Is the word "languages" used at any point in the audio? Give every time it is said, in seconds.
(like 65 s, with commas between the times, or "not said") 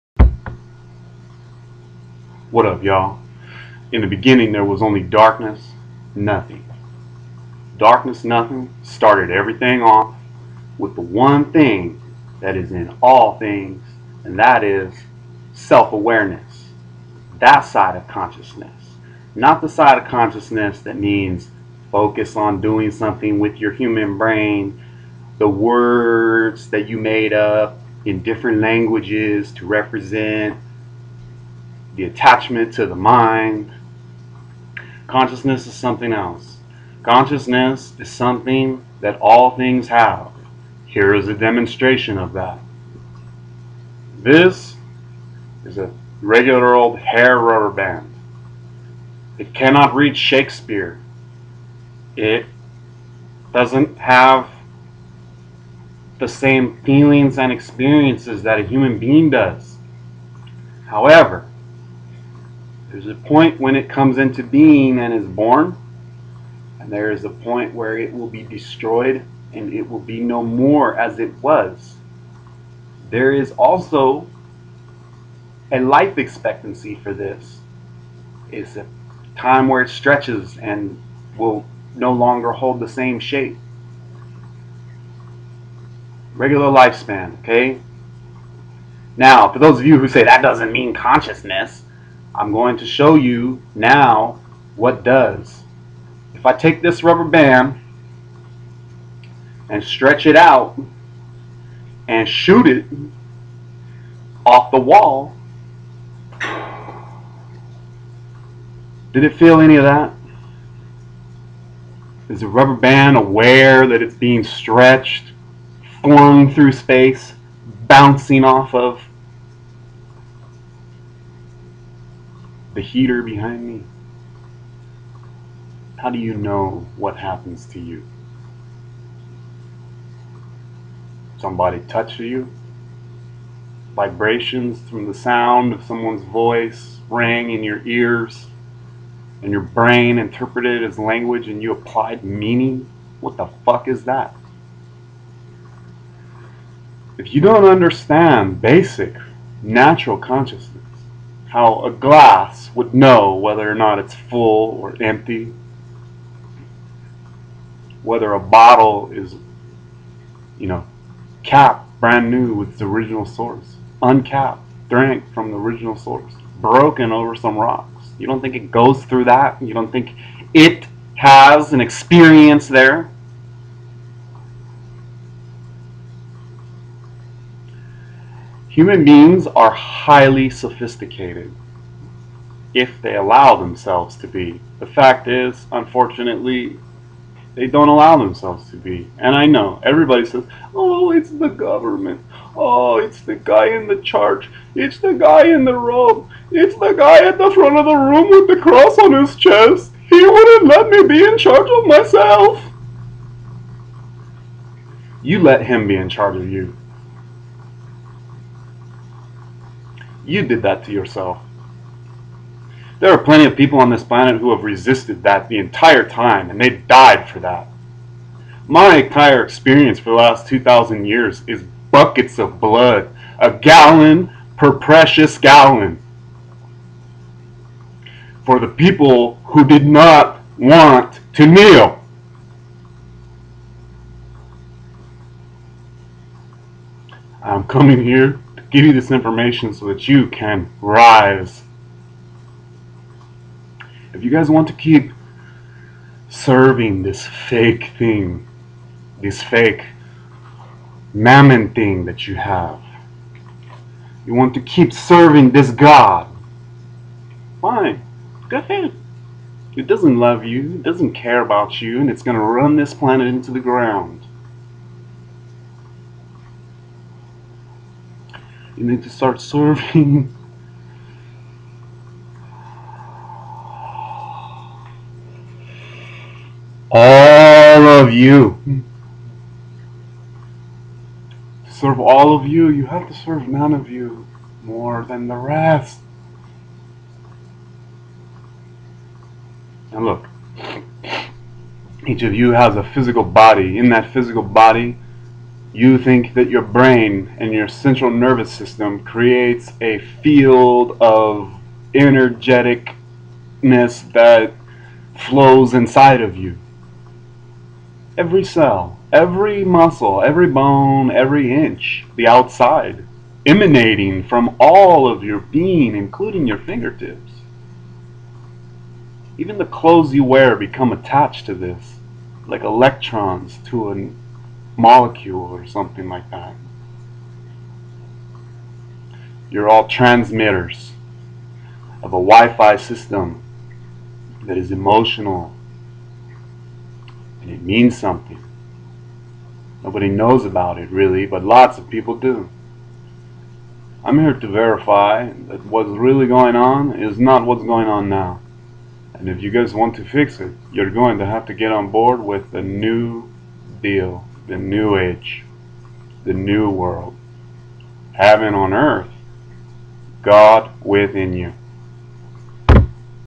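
28 s, 140 s.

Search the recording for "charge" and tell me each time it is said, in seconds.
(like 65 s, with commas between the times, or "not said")
201 s, 206 s.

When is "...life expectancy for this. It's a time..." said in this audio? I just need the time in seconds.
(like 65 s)
75 s.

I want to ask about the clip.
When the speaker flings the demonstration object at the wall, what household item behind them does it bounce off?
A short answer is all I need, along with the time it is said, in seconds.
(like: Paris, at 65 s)
heater, at 122 s.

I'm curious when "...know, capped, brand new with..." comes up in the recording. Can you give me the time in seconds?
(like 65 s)
160 s.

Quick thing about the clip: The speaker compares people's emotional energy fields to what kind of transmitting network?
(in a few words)
Wi-Fi system.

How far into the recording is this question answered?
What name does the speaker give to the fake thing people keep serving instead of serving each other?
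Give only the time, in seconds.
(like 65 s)
251 s.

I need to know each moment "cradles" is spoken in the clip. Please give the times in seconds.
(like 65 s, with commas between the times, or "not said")
not said.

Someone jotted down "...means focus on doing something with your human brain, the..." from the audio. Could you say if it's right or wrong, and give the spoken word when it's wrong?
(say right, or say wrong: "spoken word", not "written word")
right.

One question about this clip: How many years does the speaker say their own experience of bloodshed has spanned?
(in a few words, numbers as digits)
2,000 years.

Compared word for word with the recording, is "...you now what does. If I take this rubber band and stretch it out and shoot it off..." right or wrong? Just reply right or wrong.
right.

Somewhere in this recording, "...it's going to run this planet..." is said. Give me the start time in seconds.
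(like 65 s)
262 s.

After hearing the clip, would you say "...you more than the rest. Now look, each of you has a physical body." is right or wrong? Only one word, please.
right.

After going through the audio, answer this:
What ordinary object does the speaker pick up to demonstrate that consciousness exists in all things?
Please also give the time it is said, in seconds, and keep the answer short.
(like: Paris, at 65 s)
hair rubber band, at 46 s.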